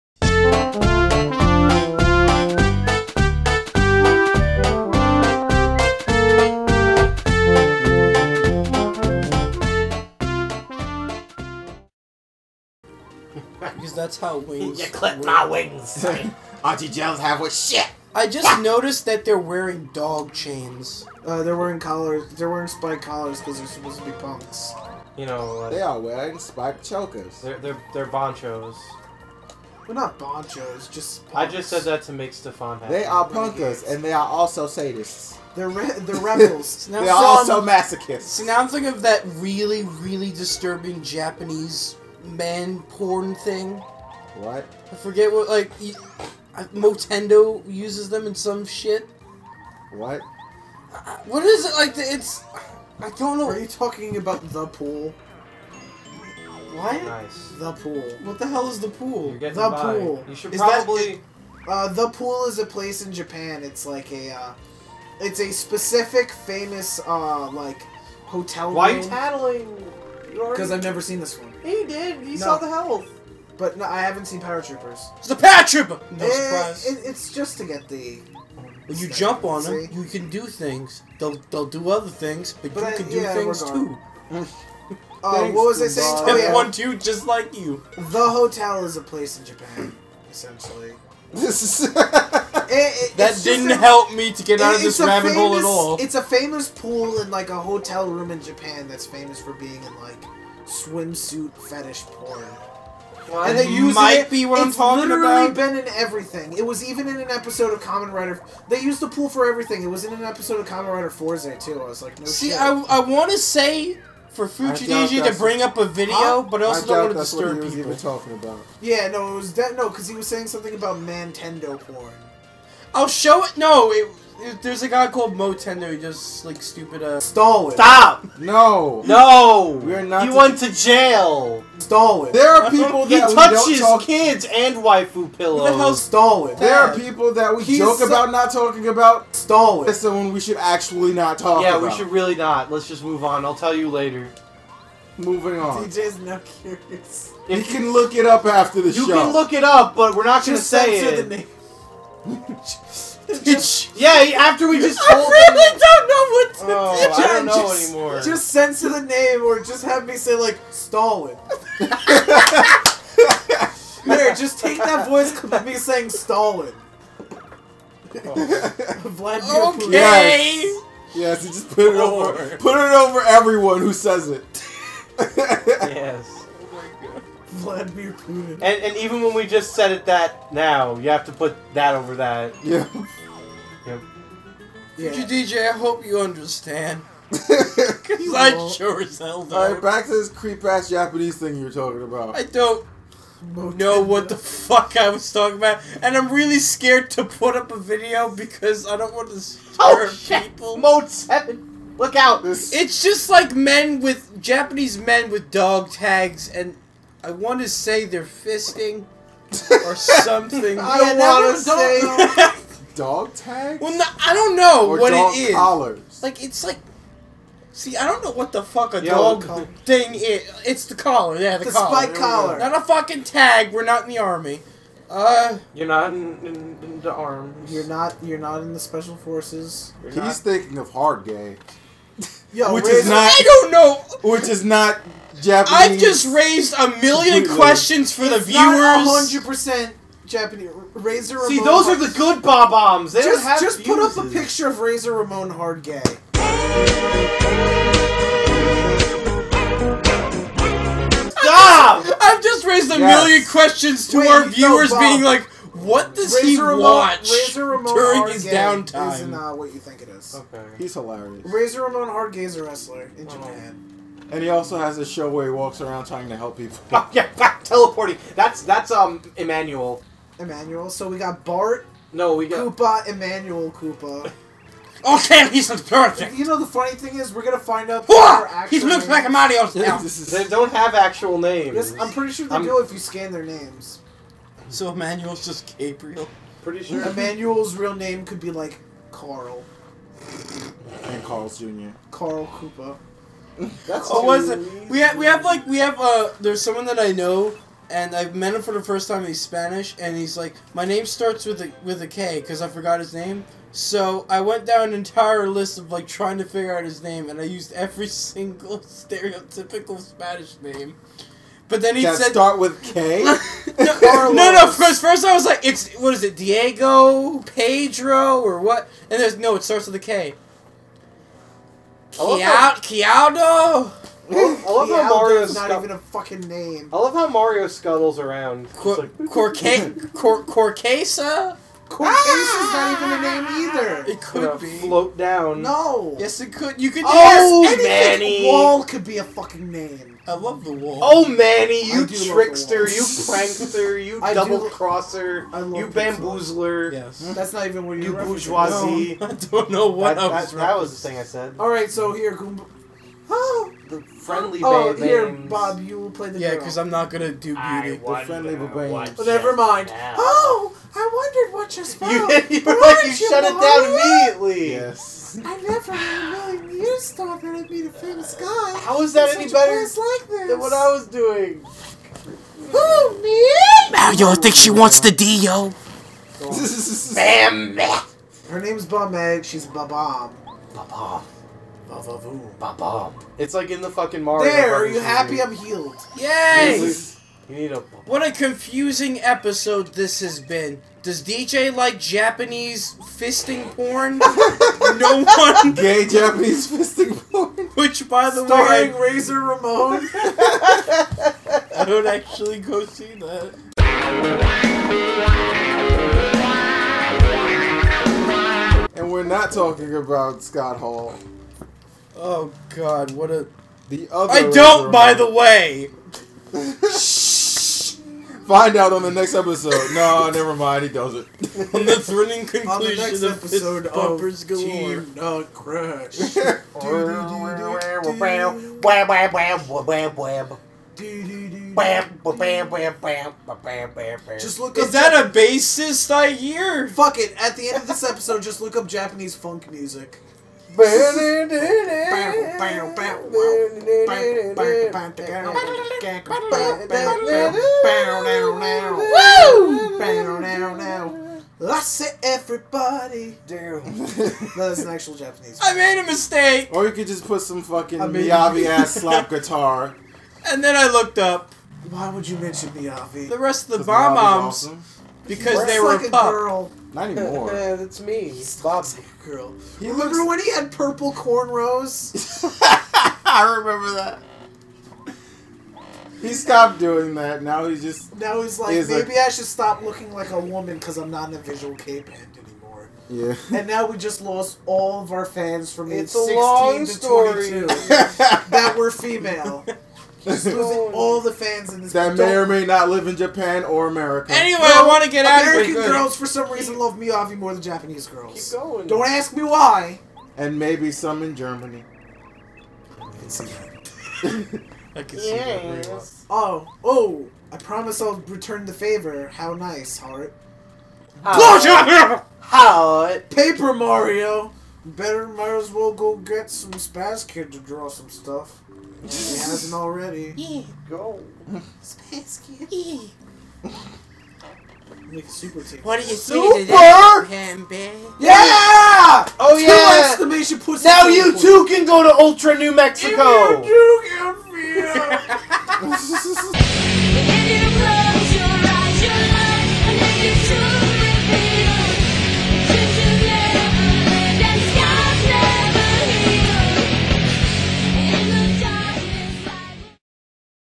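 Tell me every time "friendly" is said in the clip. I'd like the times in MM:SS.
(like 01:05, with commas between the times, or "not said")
05:54, 05:58.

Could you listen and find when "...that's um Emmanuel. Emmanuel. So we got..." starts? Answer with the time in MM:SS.
04:28.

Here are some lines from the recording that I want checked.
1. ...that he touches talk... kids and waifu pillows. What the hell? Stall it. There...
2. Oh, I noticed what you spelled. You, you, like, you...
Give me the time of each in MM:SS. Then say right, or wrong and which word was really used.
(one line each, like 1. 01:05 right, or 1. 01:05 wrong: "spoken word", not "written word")
1. 02:13 right
2. 06:00 wrong: "wondered", not "noticed".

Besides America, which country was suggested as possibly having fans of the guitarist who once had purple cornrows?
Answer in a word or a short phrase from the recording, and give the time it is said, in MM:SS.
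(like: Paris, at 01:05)
Germany, at 08:21.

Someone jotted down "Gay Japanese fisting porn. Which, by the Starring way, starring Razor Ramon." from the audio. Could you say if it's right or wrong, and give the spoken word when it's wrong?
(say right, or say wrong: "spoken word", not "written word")
right.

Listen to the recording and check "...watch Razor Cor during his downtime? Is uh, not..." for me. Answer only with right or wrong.
wrong.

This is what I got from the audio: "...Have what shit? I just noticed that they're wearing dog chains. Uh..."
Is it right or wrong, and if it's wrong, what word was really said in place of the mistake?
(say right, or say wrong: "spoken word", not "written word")
right.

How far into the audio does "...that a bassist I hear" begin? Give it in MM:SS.
07:14.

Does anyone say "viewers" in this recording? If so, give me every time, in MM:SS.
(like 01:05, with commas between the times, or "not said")
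03:58, 04:14.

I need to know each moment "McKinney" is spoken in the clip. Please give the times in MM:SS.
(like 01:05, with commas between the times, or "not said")
not said.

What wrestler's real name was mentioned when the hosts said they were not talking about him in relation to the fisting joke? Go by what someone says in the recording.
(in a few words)
Scott Hall.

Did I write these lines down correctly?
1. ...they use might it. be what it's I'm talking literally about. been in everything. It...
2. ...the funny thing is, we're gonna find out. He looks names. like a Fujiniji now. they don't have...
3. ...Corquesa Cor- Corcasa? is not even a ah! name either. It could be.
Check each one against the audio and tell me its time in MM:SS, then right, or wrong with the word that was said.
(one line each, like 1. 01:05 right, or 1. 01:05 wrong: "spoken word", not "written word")
1. 01:43 right
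2. 04:36 wrong: "Mario", not "Fujiniji"
3. 05:29 right.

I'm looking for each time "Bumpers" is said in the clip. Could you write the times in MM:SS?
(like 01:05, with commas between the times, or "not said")
07:03.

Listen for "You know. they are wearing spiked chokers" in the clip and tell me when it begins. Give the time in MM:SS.
00:25.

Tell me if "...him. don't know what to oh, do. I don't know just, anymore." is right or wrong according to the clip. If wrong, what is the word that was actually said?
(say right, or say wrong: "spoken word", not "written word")
right.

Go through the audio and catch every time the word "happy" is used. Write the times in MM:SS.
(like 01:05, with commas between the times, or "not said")
00:32, 06:25.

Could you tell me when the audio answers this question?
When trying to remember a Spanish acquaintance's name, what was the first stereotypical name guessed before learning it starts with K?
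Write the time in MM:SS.
05:16.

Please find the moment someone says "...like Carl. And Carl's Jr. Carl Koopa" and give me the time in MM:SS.
04:48.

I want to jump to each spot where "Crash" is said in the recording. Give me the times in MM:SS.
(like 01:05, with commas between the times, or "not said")
07:05.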